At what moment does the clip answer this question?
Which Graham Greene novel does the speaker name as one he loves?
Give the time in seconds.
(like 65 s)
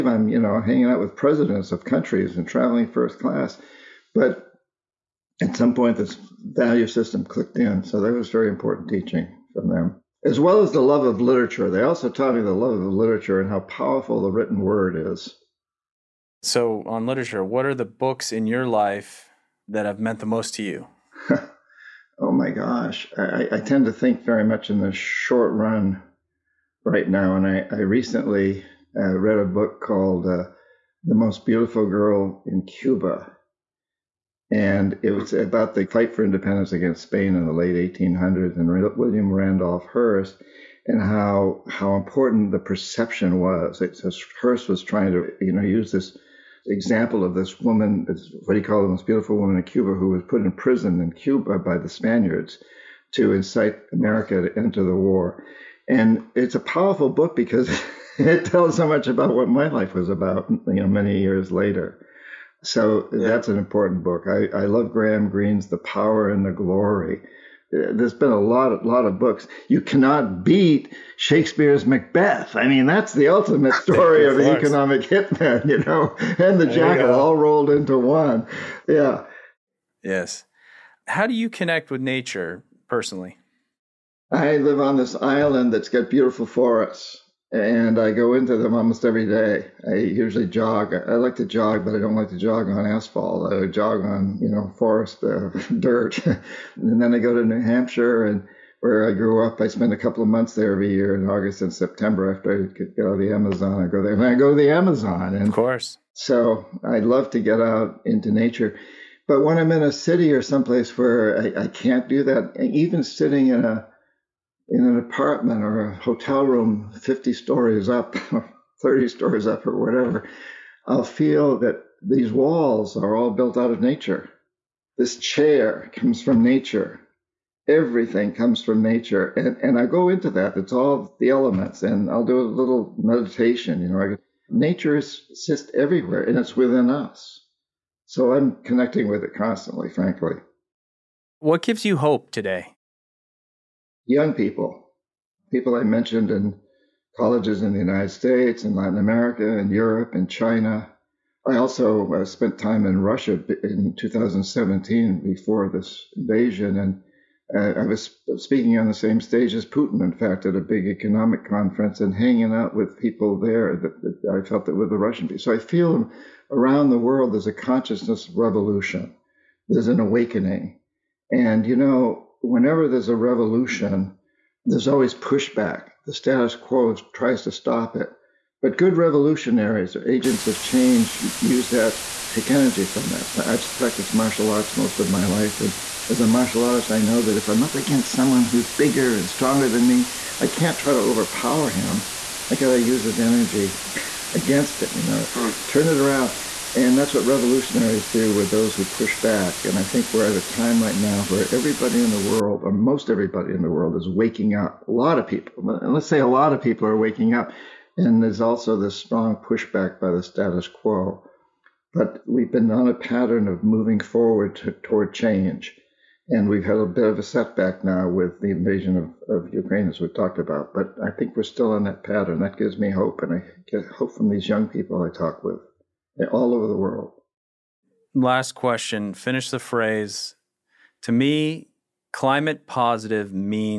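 65 s.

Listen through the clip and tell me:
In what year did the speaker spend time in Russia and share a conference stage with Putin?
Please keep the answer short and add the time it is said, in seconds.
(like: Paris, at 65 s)
2017, at 153 s.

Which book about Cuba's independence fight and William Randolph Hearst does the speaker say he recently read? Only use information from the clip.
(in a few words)
The Most Beautiful Girl in Cuba.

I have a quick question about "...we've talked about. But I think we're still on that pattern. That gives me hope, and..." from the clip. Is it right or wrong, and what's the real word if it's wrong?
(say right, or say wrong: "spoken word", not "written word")
right.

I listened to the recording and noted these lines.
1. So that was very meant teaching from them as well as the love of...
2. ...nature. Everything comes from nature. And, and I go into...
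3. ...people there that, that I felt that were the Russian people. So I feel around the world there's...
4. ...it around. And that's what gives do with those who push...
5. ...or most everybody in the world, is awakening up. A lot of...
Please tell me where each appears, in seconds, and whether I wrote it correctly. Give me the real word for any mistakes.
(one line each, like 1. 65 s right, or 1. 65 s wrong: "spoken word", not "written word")
1. 7 s wrong: "important", not "meant"
2. 126 s right
3. 162 s right
4. 195 s wrong: "revolutionaries", not "gives"
5. 202 s wrong: "waking", not "awakening".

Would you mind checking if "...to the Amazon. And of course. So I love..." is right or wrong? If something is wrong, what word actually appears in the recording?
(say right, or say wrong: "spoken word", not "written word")
right.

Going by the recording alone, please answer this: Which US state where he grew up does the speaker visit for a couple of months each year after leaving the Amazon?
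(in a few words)
New Hampshire.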